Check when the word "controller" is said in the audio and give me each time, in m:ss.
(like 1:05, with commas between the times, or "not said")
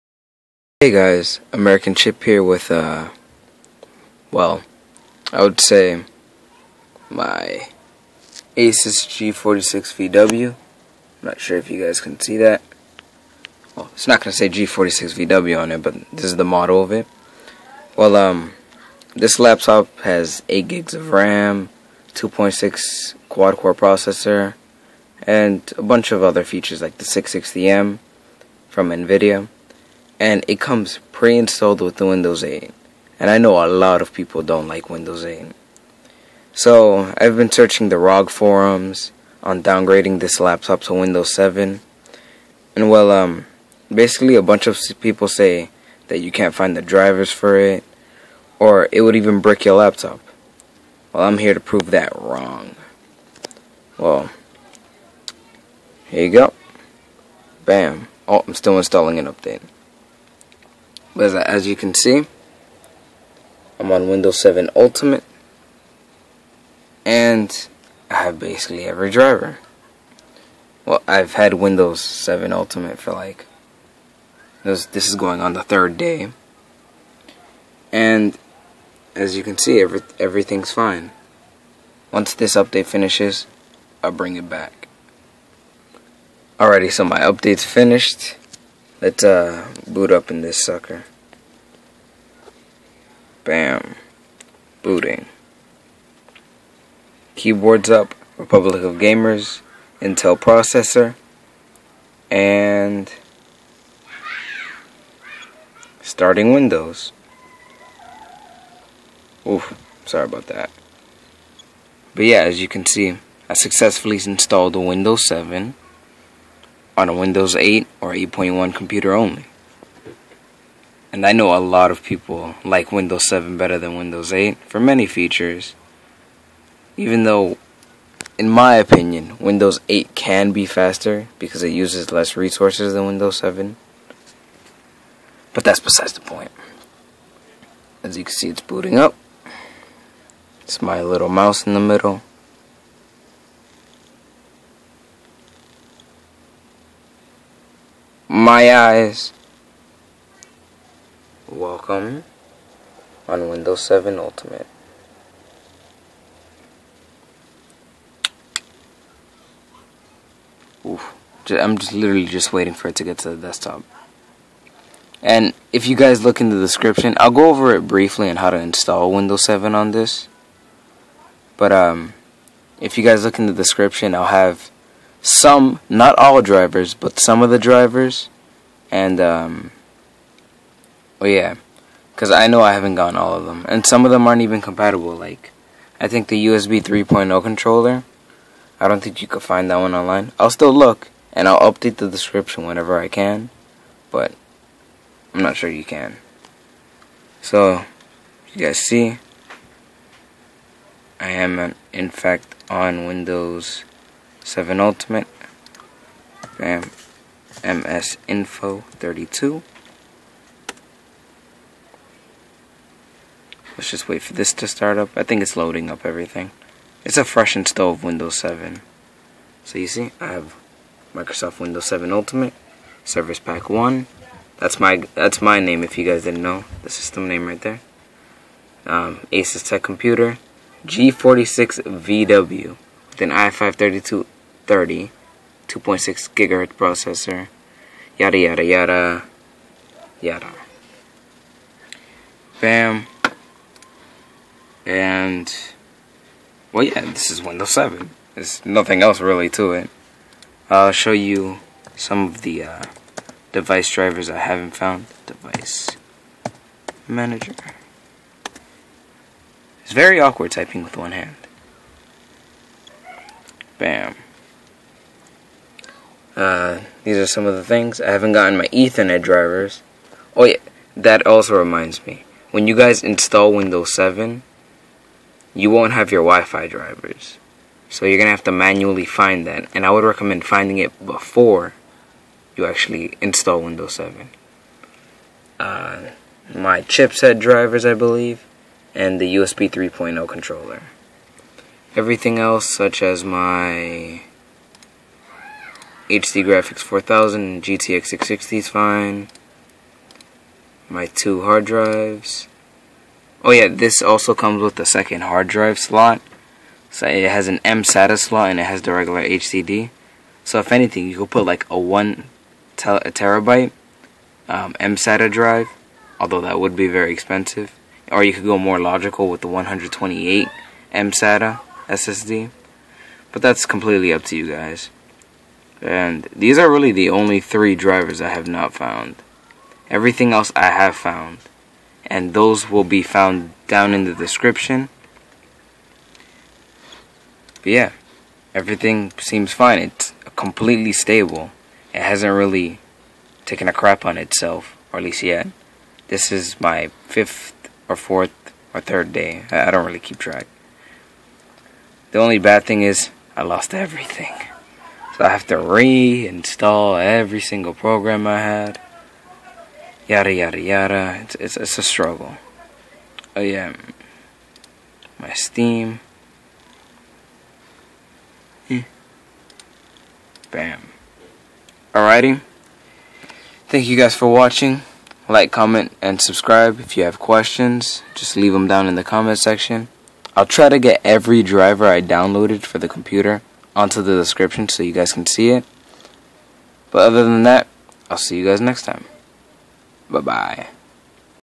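3:07, 4:50.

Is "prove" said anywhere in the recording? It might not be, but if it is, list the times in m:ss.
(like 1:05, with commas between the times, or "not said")
0:51.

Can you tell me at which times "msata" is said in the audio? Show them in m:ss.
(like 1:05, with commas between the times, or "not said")
5:07, 5:14, 5:20.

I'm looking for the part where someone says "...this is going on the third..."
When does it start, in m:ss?
1:14.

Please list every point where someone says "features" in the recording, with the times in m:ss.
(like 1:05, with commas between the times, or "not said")
0:26, 2:05.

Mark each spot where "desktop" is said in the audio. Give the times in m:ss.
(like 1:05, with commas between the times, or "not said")
2:43.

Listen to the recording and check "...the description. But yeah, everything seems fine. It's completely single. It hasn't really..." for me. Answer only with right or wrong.
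wrong.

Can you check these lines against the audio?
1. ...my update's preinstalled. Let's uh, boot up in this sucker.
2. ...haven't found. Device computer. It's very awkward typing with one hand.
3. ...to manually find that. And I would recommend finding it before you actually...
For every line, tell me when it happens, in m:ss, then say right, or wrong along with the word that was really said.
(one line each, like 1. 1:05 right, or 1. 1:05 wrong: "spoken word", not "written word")
1. 1:27 wrong: "finished", not "preinstalled"
2. 4:14 wrong: "manager", not "computer"
3. 4:38 right.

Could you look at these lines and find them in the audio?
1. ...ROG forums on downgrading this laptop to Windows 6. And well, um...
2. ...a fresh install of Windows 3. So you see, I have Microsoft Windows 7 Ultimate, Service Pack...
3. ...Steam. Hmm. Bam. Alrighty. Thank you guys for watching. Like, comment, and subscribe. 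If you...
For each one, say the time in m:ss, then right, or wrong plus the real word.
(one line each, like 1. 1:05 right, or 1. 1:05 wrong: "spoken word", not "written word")
1. 0:37 wrong: "7", not "6"
2. 3:37 wrong: "7", not "3"
3. 6:05 right.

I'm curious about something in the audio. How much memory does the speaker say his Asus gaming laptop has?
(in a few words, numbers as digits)
8 GB.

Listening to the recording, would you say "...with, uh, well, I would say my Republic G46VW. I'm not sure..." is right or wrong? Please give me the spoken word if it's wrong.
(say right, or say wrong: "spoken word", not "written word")
wrong: "Asus", not "Republic".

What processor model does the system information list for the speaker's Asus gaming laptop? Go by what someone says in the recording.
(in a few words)
i5-3230.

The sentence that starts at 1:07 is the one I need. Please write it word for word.
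And I have basically every driver.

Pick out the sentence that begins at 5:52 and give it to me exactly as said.
The only bad thing is I lost everything.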